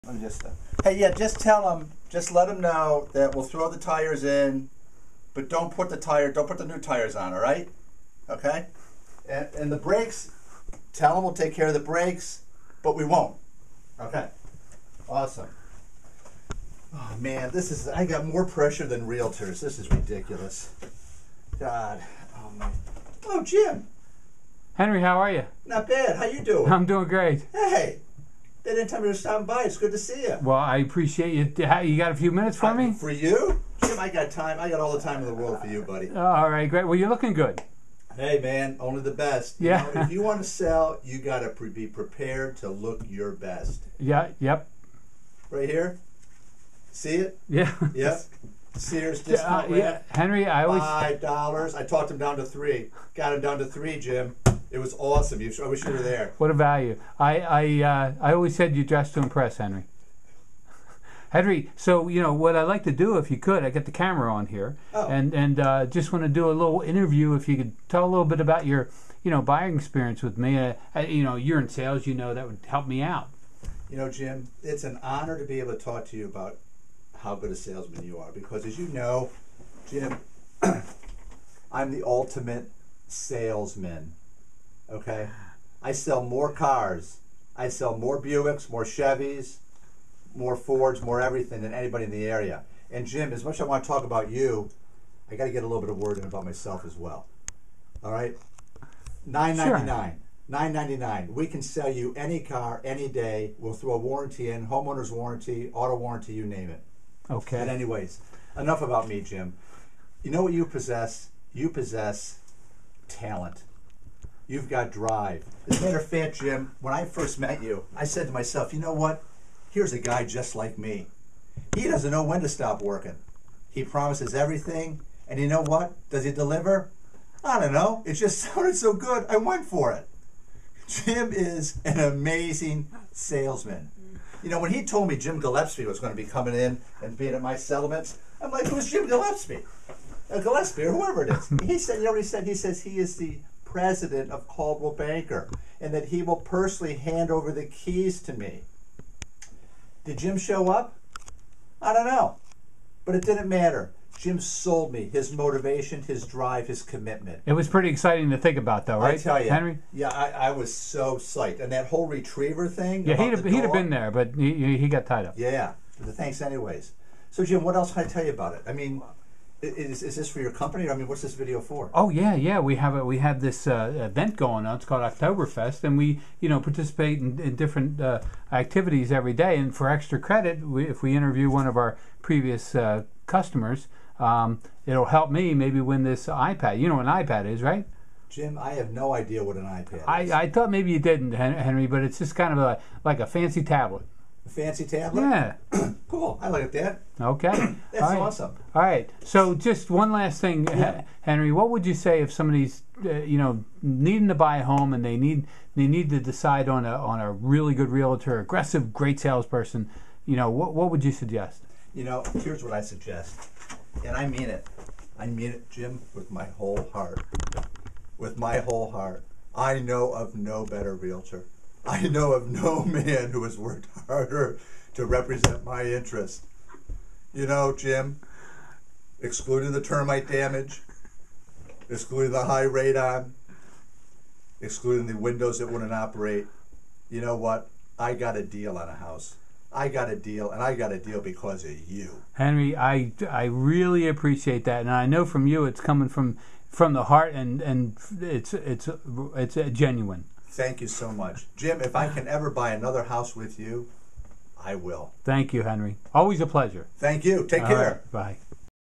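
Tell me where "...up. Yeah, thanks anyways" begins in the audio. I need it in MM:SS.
02:45.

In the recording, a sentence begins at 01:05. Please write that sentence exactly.
and and uh, just want to do a little interview.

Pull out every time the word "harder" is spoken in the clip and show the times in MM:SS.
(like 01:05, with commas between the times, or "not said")
03:44.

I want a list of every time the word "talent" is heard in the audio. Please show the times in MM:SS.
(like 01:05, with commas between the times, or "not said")
01:53.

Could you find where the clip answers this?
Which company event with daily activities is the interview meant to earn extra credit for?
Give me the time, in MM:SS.
02:55.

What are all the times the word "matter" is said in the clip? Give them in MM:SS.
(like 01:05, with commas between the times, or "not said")
01:55, 02:33.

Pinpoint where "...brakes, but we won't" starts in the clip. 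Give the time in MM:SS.
00:11.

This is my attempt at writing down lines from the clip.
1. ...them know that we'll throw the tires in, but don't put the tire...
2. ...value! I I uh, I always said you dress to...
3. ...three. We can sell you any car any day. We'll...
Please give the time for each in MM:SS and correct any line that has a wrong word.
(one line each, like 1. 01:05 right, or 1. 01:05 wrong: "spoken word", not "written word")
1. 00:02 right
2. 00:56 right
3. 01:40 wrong: "nine", not "three".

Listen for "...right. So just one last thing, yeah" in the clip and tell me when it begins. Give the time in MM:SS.
03:18.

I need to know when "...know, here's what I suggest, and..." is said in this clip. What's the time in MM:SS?
03:32.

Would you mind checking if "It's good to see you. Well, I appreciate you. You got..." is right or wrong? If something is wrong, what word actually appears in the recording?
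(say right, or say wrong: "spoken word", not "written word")
right.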